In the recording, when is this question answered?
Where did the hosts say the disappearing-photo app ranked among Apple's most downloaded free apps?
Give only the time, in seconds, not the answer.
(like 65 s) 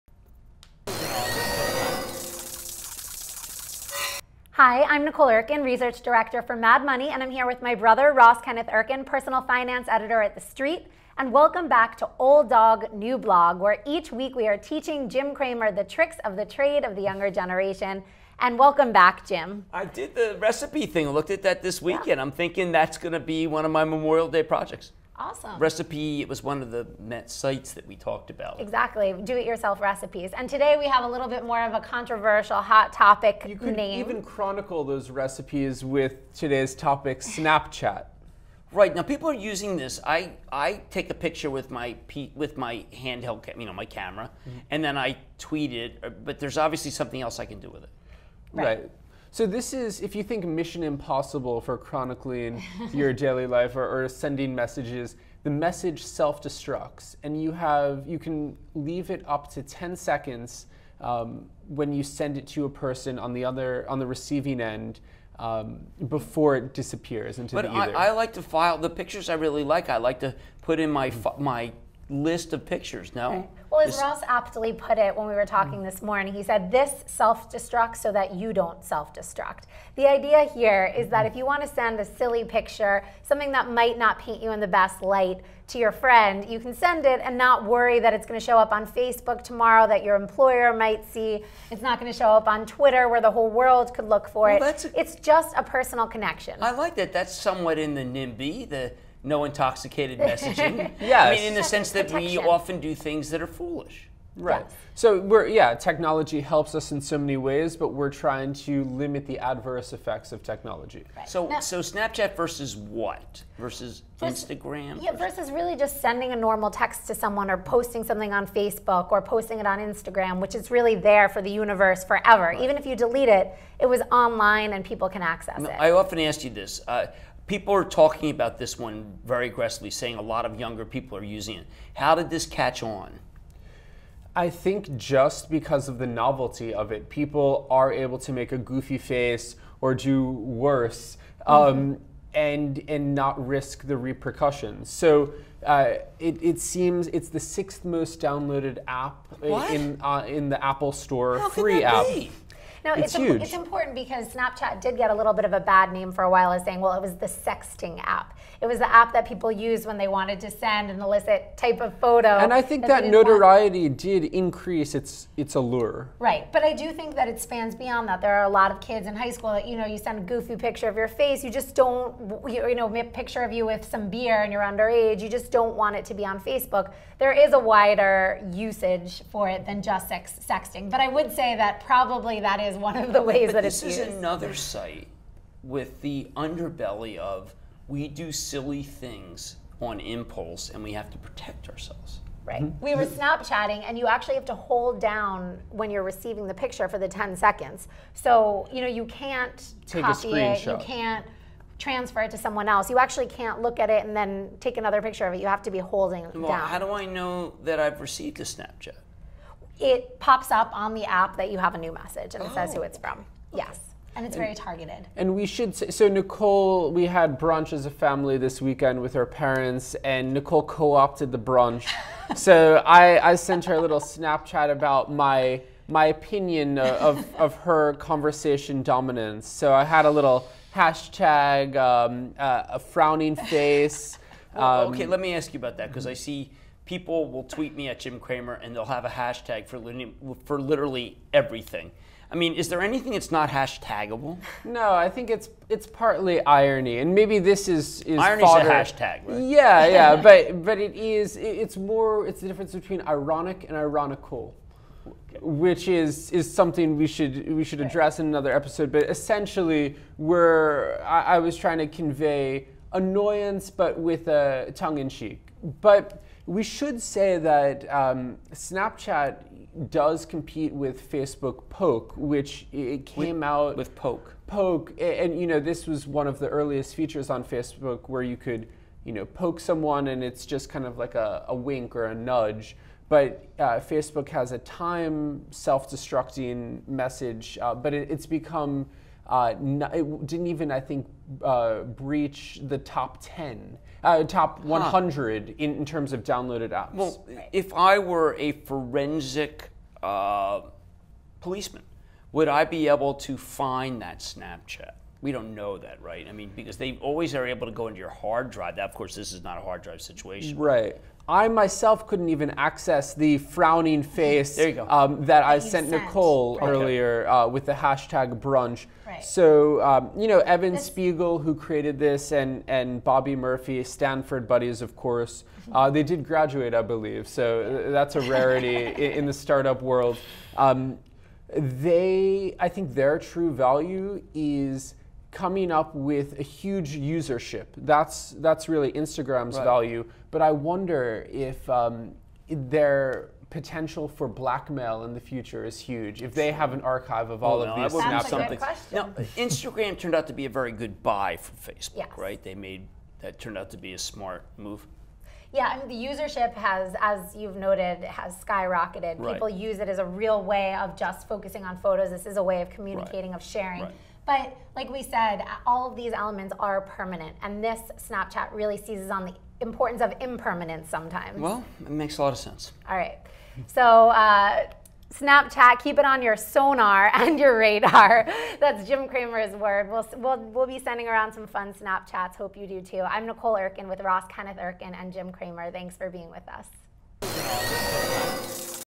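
147 s.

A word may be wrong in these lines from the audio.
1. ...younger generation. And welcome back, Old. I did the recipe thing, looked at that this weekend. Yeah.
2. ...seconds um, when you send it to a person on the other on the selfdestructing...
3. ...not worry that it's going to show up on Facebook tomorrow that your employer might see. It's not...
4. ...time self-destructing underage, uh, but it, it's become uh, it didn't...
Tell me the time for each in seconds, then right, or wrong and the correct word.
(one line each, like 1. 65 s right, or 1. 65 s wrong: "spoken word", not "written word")
1. 17 s wrong: "Jim", not "Old"
2. 59 s wrong: "receiving", not "selfdestructing"
3. 87 s right
4. 284 s wrong: "message", not "underage".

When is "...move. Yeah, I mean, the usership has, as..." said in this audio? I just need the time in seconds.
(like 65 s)
354 s.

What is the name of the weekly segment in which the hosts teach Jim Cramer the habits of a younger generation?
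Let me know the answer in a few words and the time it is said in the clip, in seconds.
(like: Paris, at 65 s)
Old Dog New Blog, at 12 s.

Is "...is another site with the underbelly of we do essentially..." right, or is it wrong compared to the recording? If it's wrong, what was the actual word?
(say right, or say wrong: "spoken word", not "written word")
wrong: "silly", not "essentially".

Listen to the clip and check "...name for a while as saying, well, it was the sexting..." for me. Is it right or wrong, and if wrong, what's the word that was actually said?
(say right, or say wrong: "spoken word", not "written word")
right.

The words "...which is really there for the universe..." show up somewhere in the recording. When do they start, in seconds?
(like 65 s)
120 s.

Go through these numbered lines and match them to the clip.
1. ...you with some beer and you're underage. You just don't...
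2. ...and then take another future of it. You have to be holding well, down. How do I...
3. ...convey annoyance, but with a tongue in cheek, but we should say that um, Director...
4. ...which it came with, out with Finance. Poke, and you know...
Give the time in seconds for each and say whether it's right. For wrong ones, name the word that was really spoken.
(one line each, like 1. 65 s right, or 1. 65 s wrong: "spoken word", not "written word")
1. 173 s right
2. 204 s wrong: "picture", not "future"
3. 261 s wrong: "Snapchat", not "Director"
4. 272 s wrong: "Poke", not "Finance".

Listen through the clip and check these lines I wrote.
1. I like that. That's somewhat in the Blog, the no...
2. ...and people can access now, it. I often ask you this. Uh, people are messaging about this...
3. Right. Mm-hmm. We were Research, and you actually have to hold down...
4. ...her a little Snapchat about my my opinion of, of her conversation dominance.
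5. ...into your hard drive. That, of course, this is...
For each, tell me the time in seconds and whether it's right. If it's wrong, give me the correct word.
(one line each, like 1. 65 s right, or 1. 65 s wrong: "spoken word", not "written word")
1. 96 s wrong: "NIMBY", not "Blog"
2. 124 s wrong: "talking", not "messaging"
3. 192 s wrong: "Snapchatting", not "Research"
4. 223 s right
5. 307 s right.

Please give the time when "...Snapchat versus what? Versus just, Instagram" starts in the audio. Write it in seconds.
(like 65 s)
111 s.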